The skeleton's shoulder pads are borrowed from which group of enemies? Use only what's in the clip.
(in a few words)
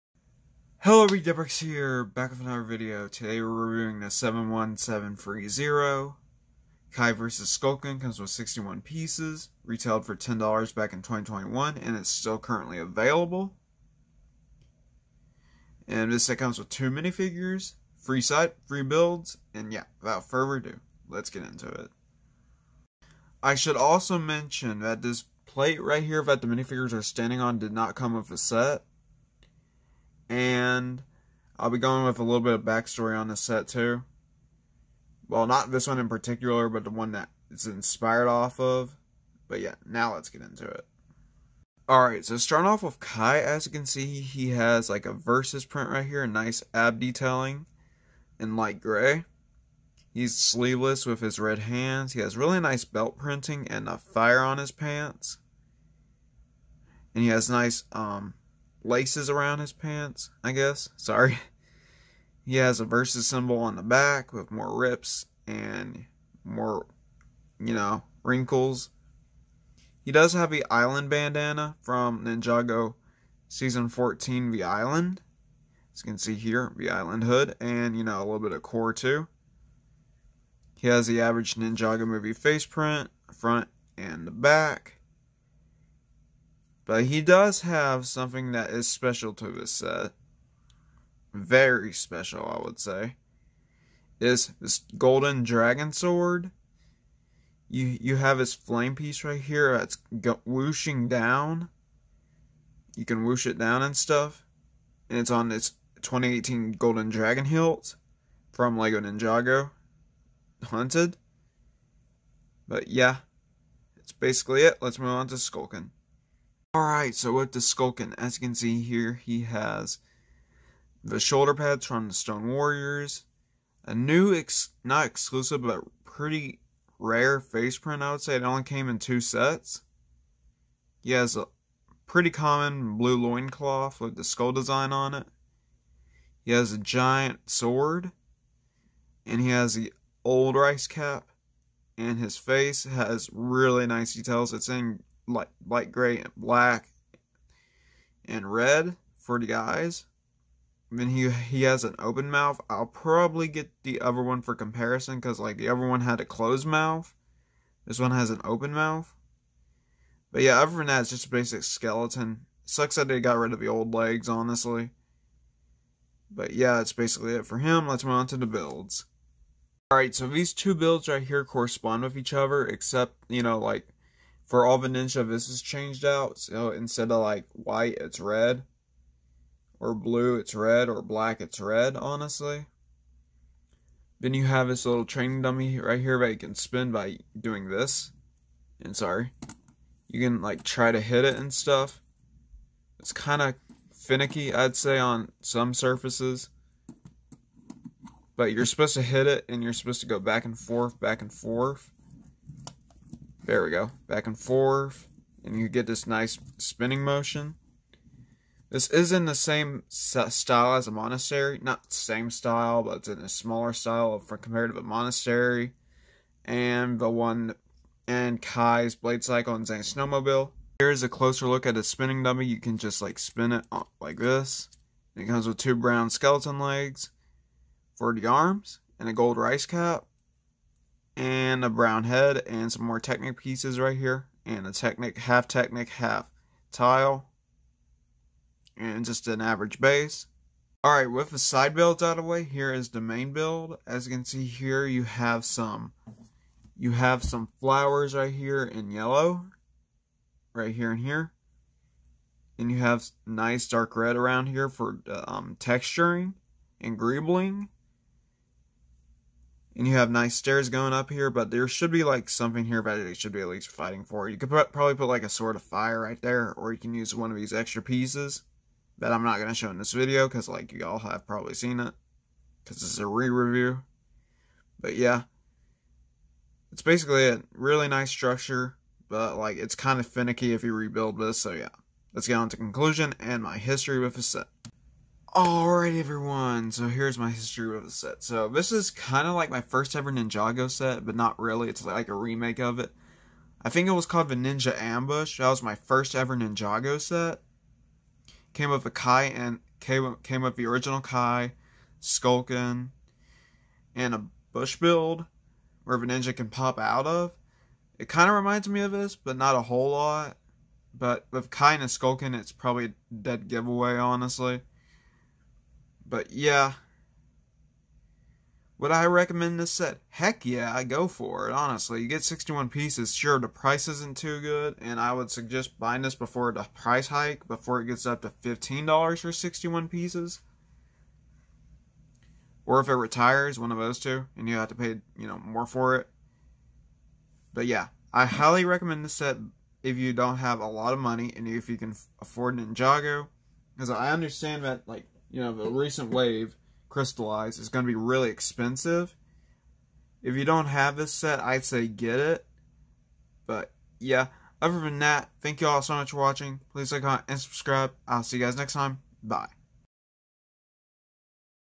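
Stone Warriors.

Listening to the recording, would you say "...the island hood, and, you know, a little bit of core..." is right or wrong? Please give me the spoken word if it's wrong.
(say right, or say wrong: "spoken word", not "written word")
right.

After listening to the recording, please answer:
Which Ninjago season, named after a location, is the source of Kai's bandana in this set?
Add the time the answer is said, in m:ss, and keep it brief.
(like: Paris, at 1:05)
Season 14 The Island, at 1:13.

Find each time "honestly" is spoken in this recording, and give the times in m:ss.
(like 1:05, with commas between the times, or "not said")
2:44, 3:01, 5:13, 5:21.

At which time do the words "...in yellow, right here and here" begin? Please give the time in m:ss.
4:08.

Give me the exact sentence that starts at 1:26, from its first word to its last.
But he does have something that is special to this set.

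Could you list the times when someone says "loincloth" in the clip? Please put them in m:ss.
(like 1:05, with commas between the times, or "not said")
2:13.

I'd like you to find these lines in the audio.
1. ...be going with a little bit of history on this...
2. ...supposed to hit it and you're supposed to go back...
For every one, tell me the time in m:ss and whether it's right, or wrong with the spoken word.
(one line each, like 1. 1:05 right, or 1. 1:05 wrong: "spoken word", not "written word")
1. 0:31 wrong: "backstory", not "history"
2. 3:18 right.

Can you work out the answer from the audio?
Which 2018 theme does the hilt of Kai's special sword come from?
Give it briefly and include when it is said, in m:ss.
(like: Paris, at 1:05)
Lego Ninjago Hunted, at 1:48.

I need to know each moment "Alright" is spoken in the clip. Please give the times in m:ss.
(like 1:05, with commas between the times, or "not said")
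0:41, 1:56, 2:49, 4:00, 4:45.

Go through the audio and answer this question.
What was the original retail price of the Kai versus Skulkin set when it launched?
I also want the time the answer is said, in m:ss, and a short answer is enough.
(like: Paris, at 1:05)
$10, at 0:10.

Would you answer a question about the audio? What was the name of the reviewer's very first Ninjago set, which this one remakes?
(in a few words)
Ninja Ambush.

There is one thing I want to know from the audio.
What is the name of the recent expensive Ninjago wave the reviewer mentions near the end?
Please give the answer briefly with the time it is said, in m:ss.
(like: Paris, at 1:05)
Crystalized, at 5:46.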